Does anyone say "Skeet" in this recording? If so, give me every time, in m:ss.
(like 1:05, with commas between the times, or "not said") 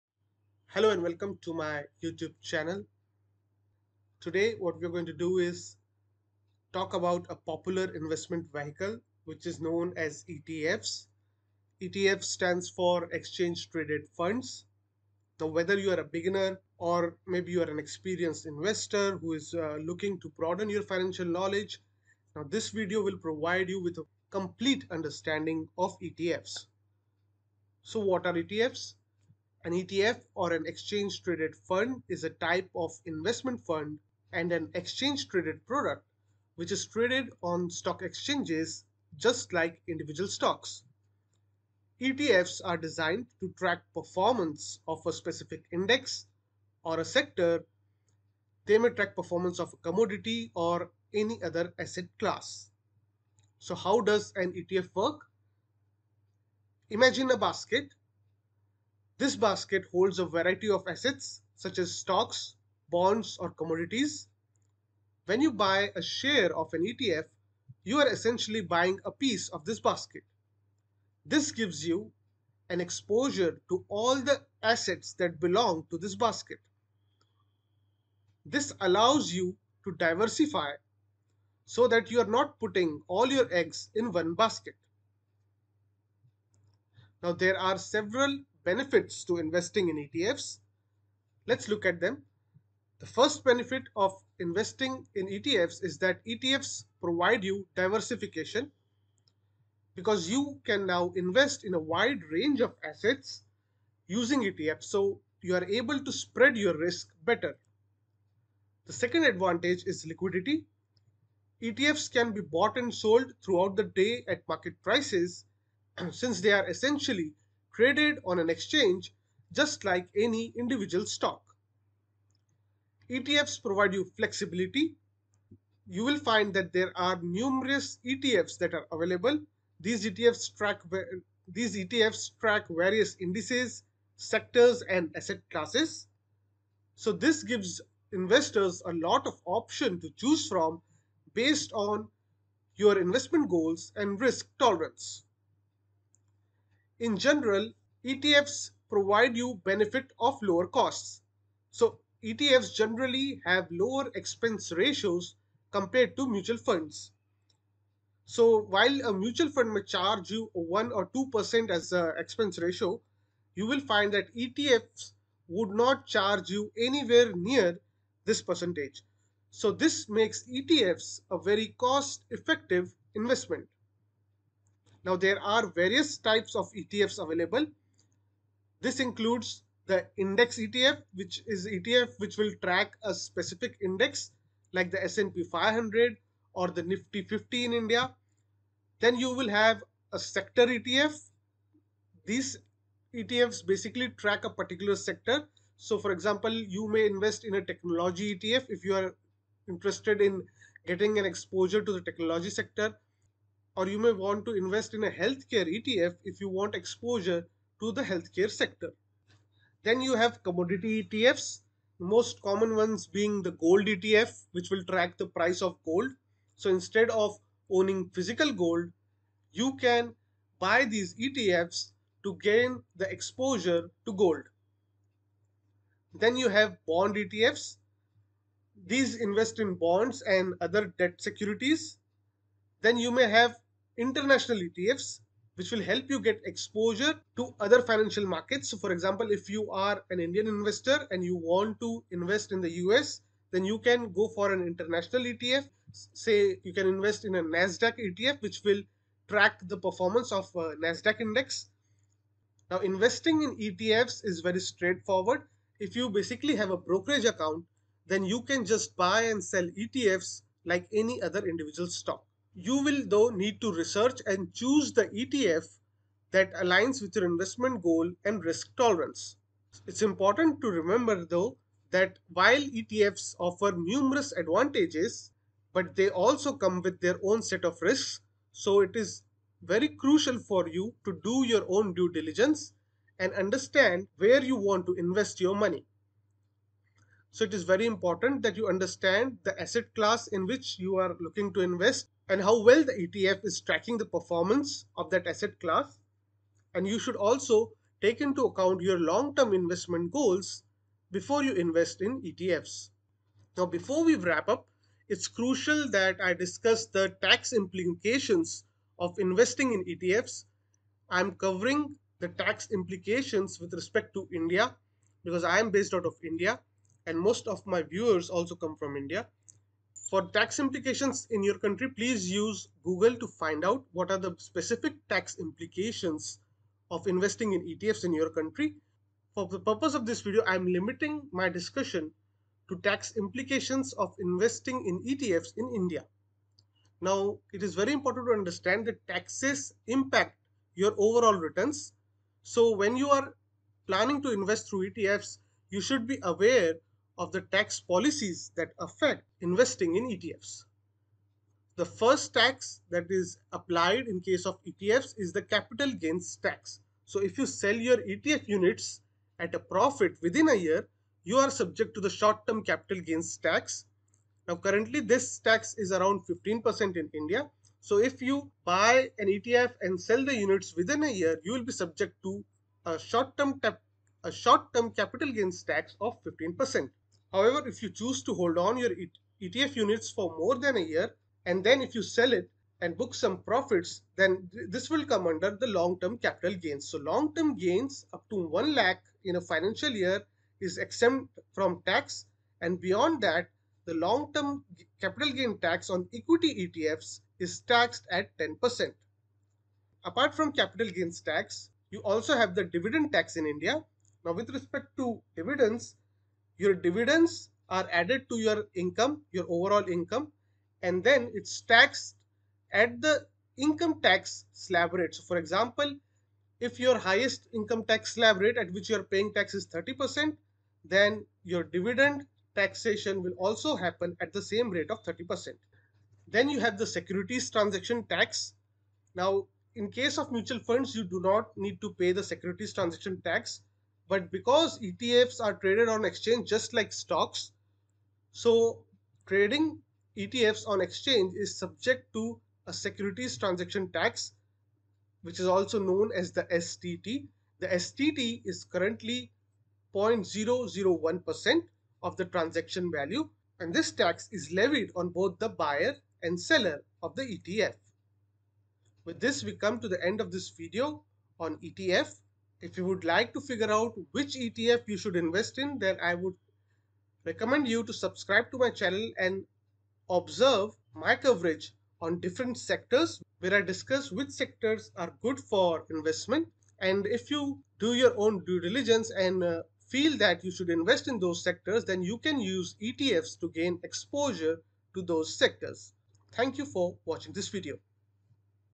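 not said.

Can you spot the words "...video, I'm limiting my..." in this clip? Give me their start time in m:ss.
5:30.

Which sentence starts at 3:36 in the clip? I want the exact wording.
So instead of owning physical gold, you can buy these ETFs to gain the exposure to gold.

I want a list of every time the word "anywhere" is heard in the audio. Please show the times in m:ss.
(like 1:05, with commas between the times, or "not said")
2:46.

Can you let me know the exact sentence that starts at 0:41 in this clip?
ETFs are designed to track performance of a specific index or a sector.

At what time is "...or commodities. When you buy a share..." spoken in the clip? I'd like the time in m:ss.
1:03.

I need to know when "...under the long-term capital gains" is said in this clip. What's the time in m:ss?
6:25.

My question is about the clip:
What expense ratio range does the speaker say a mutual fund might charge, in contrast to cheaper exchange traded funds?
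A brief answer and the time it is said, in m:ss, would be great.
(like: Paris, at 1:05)
1 or 2%, at 2:40.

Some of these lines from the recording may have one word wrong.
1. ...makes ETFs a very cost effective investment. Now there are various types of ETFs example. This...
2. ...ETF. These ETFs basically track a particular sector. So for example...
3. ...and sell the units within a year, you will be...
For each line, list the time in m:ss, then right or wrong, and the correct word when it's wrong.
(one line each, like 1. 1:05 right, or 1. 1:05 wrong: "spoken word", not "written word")
1. 2:50 wrong: "available", not "example"
2. 3:10 right
3. 6:09 right.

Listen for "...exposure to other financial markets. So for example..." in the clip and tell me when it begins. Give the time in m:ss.
3:56.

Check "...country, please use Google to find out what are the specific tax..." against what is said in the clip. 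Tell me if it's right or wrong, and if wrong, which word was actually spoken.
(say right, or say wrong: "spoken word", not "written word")
right.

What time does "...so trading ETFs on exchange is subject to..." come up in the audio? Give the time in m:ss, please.
7:18.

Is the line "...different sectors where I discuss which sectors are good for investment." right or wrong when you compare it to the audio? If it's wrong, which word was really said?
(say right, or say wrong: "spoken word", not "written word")
right.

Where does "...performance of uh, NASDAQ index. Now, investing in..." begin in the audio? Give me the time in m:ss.
4:09.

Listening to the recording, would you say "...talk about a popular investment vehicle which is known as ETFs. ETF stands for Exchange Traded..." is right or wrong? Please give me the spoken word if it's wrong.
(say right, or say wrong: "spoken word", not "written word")
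right.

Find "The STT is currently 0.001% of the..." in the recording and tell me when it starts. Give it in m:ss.
7:27.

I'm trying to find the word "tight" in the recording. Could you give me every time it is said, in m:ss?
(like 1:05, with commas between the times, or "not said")
not said.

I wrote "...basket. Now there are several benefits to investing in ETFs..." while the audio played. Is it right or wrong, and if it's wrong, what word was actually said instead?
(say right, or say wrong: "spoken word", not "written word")
right.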